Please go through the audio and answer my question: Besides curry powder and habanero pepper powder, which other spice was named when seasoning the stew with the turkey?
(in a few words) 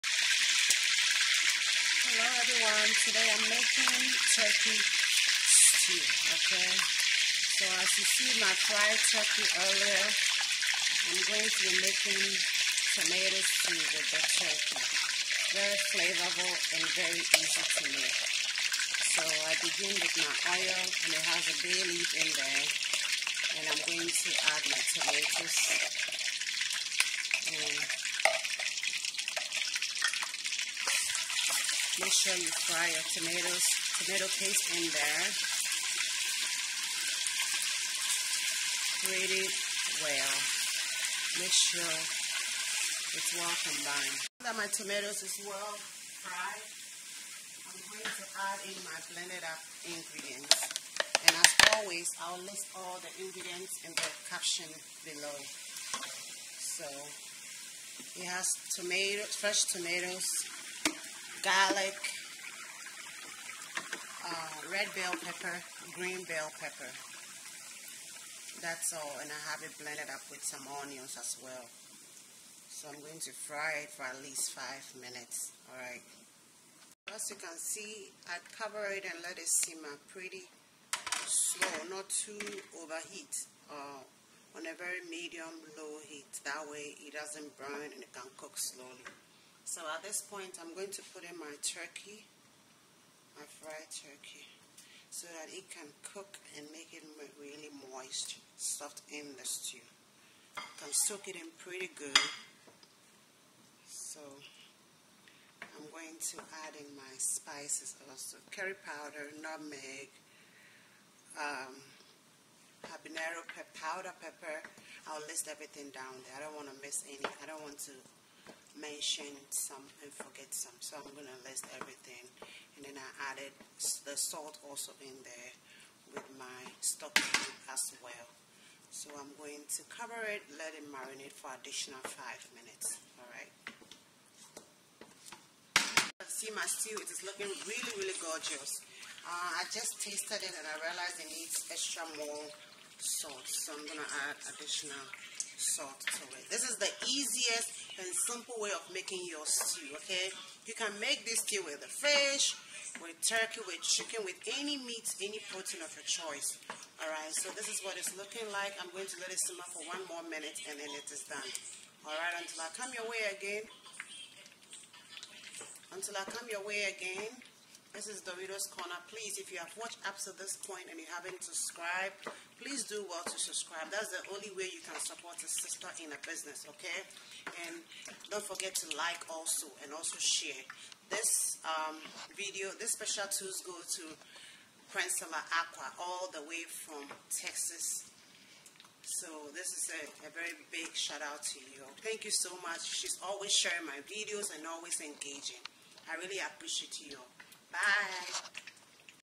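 nutmeg.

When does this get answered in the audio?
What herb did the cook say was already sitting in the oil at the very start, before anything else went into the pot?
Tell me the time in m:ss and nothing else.
0:21.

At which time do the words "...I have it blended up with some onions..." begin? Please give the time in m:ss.
1:09.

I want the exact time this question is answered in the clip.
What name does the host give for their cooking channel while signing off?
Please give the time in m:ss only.
2:48.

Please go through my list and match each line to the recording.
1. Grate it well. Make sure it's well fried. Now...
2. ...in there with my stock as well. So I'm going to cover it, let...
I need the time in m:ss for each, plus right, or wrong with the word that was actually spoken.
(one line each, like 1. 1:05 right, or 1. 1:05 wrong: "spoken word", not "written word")
1. 0:39 wrong: "combined", not "fried"
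2. 2:04 right.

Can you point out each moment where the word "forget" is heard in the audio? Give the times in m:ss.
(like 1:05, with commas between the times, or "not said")
2:00, 2:58.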